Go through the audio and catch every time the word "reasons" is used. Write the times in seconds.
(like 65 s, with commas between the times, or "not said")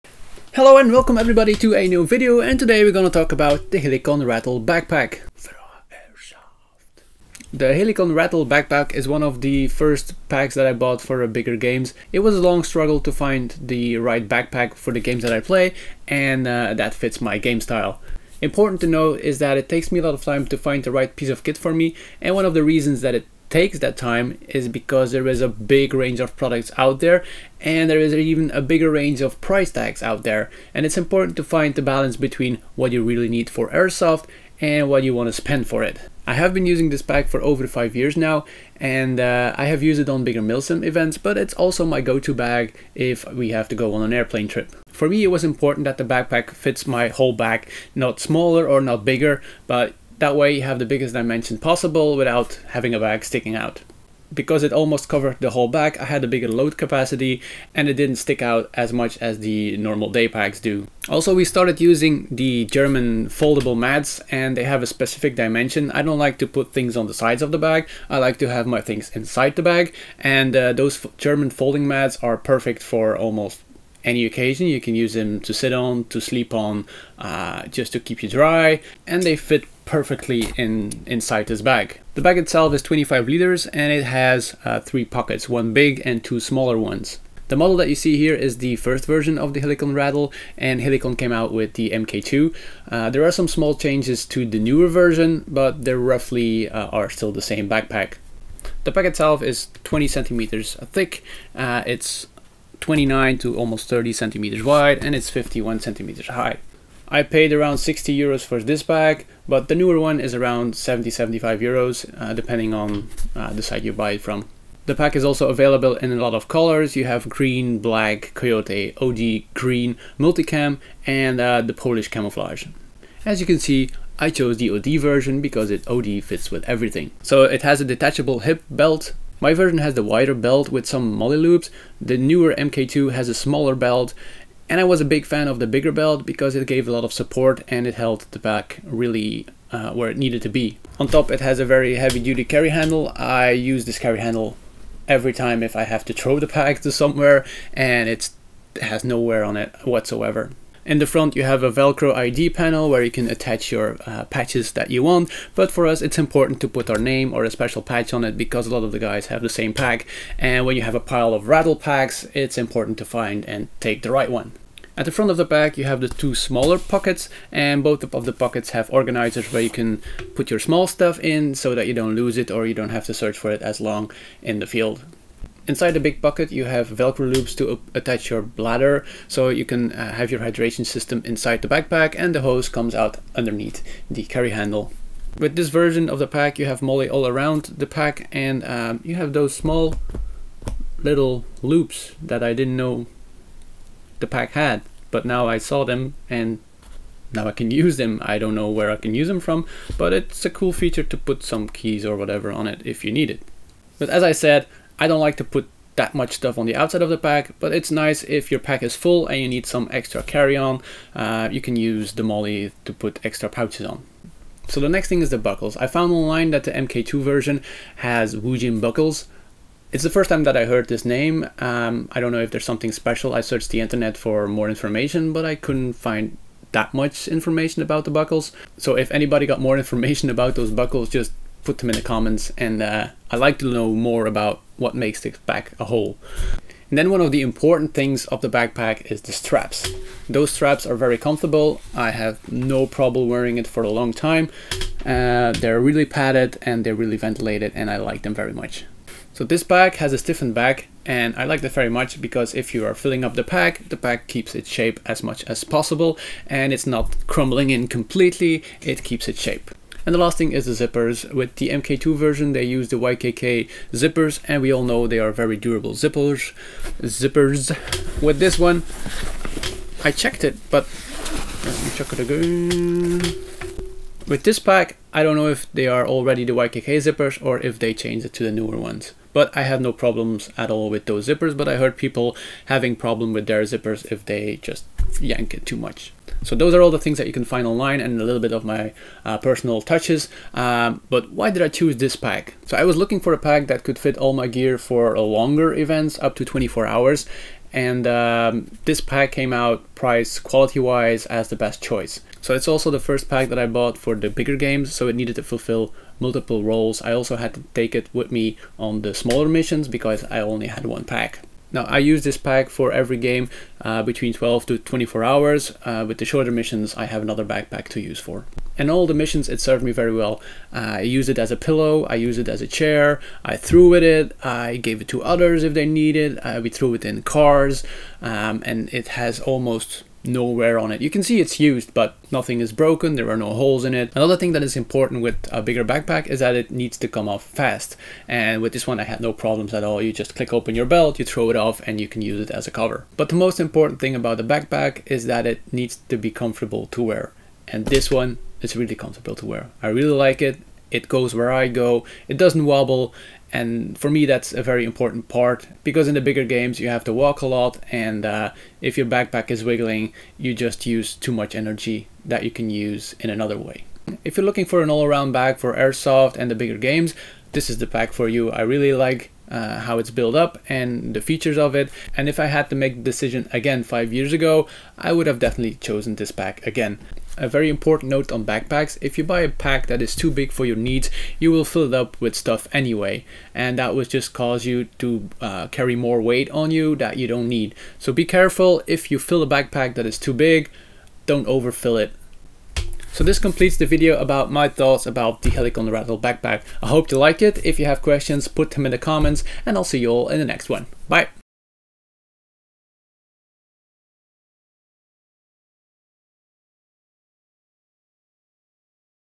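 22 s.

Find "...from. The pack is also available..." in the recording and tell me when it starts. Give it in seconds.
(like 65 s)
114 s.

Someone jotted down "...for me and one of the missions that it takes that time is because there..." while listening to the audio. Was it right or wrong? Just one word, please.
wrong.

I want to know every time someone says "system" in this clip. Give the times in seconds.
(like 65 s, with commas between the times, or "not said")
180 s.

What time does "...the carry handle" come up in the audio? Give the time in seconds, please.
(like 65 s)
184 s.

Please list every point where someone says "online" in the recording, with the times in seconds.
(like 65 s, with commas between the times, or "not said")
216 s, 287 s.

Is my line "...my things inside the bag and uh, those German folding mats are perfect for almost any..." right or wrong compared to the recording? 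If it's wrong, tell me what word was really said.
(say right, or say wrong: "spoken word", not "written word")
right.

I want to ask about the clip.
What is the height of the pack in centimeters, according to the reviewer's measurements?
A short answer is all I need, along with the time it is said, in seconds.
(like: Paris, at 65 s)
51 centimeters, at 105 s.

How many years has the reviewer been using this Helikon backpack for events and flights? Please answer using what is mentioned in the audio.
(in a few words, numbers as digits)
5 years.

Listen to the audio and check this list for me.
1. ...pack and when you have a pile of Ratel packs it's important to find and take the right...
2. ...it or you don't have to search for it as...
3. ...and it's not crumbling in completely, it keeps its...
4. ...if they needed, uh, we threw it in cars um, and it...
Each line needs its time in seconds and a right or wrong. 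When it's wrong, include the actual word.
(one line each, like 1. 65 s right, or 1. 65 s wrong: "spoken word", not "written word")
1. 159 s right
2. 172 s right
3. 256 s right
4. 325 s right.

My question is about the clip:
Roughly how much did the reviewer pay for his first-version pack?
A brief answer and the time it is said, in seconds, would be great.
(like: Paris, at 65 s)
60 euros, at 107 s.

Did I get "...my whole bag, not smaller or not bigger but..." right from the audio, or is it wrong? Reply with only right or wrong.
right.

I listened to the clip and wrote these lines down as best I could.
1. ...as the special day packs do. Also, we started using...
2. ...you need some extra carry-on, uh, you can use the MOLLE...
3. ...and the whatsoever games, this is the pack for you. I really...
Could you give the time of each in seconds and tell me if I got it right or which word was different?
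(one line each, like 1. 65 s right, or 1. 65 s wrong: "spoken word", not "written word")
1. 59 s wrong: "normal", not "special"
2. 209 s right
3. 366 s wrong: "bigger", not "whatsoever".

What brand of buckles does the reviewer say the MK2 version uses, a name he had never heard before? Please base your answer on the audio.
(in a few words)
Woojin.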